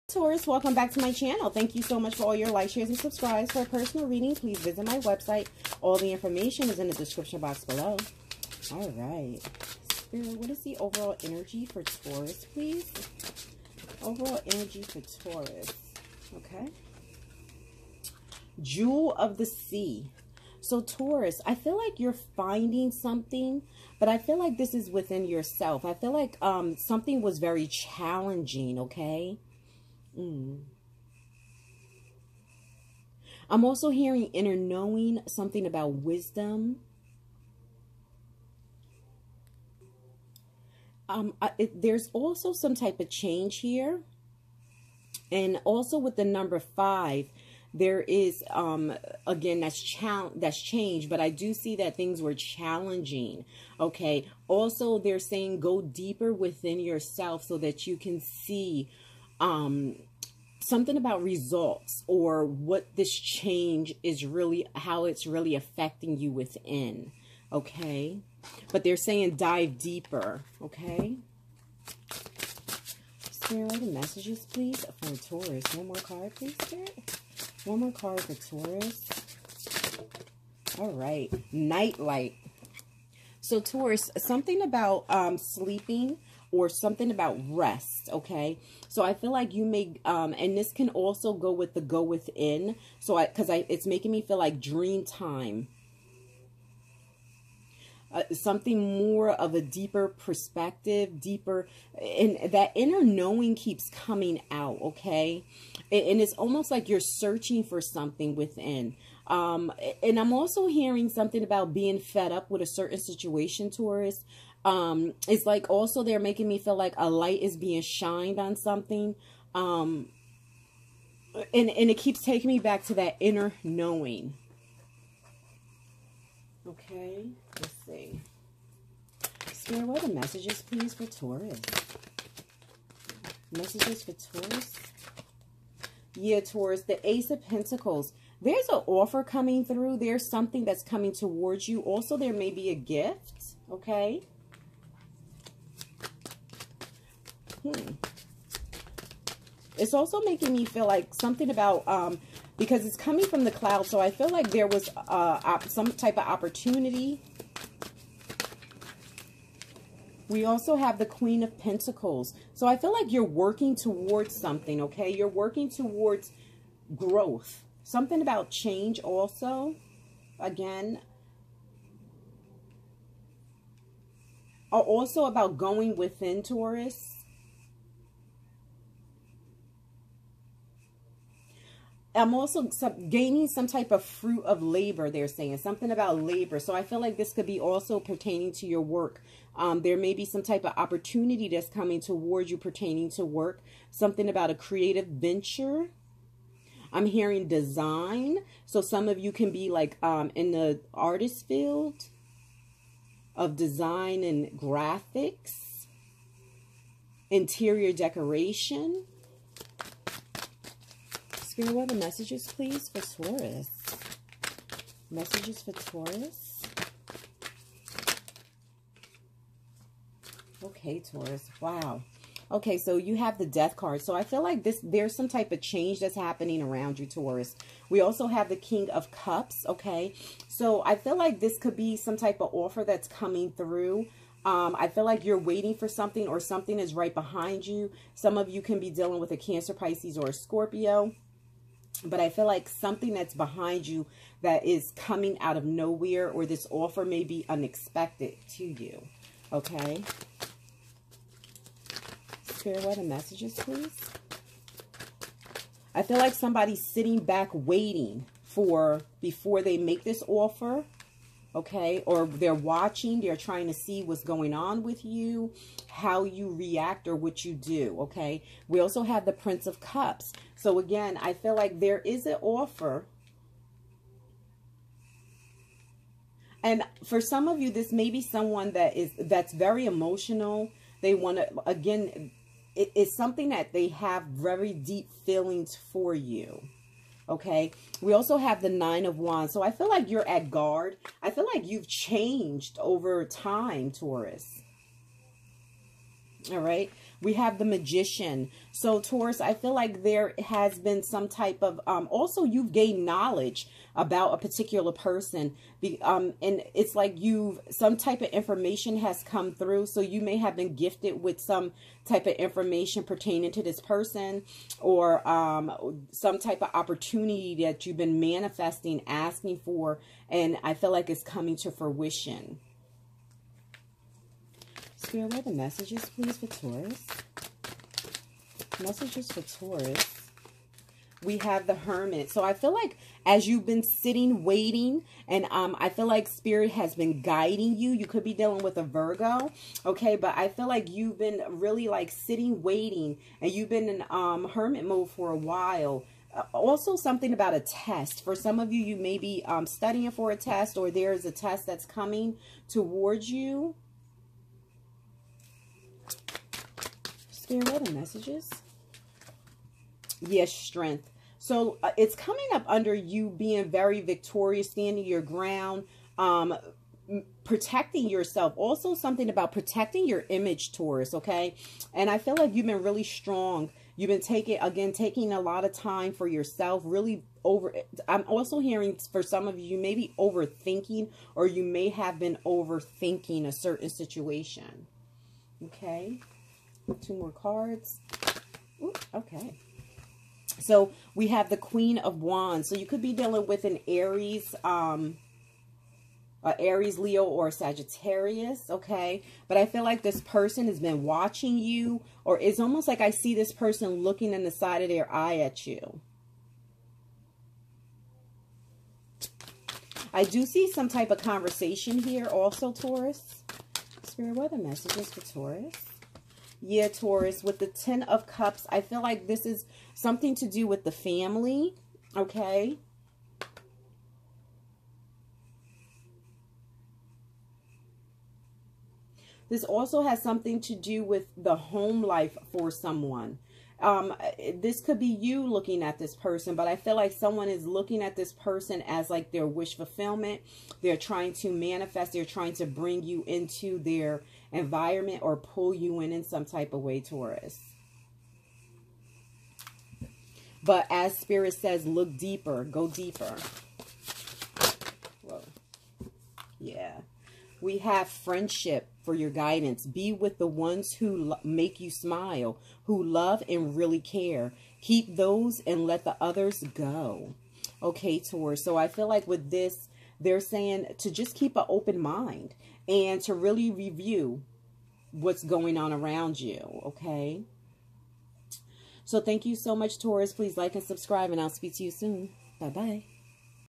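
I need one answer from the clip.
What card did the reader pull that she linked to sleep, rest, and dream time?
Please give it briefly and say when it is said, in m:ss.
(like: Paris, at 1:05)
Nightlight, at 1:21.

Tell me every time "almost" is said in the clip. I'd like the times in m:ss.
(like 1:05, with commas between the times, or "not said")
1:46, 6:42.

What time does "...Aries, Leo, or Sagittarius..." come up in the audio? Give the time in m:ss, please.
6:36.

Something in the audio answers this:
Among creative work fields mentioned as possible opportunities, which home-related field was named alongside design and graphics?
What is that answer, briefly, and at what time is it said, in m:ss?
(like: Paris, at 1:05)
Interior decoration, at 3:27.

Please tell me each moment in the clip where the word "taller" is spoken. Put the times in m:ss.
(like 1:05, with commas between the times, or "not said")
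not said.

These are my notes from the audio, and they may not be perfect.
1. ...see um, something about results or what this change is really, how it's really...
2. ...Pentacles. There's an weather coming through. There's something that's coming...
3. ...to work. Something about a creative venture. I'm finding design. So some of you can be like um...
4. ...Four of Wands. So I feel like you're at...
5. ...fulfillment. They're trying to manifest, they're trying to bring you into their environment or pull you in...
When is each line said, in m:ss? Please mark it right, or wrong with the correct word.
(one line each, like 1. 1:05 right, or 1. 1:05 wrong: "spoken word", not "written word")
1. 0:58 right
2. 2:17 wrong: "offer", not "weather"
3. 3:13 wrong: "hearing", not "finding"
4. 4:48 wrong: "Nine", not "Four"
5. 7:19 right.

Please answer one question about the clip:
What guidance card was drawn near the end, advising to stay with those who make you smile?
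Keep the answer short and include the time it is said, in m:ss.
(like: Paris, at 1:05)
Friendship, at 7:38.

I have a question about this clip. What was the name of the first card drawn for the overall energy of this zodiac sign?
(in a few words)
Jewel of the Sea.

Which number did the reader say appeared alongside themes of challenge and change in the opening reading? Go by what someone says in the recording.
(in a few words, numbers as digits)
5.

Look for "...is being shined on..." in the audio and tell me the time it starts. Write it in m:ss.
1:57.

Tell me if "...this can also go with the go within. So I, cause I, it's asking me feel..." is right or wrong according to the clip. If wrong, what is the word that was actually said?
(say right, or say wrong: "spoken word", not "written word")
wrong: "making", not "asking".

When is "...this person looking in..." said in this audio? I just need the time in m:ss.
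6:43.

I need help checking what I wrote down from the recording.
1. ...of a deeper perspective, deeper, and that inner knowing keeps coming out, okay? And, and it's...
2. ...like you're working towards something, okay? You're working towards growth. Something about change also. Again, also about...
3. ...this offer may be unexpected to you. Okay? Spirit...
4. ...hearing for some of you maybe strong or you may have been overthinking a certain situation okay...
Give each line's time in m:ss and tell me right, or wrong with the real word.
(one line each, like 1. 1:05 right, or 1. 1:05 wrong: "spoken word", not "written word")
1. 1:39 right
2. 2:42 right
3. 4:06 right
4. 6:18 wrong: "overthinking", not "strong".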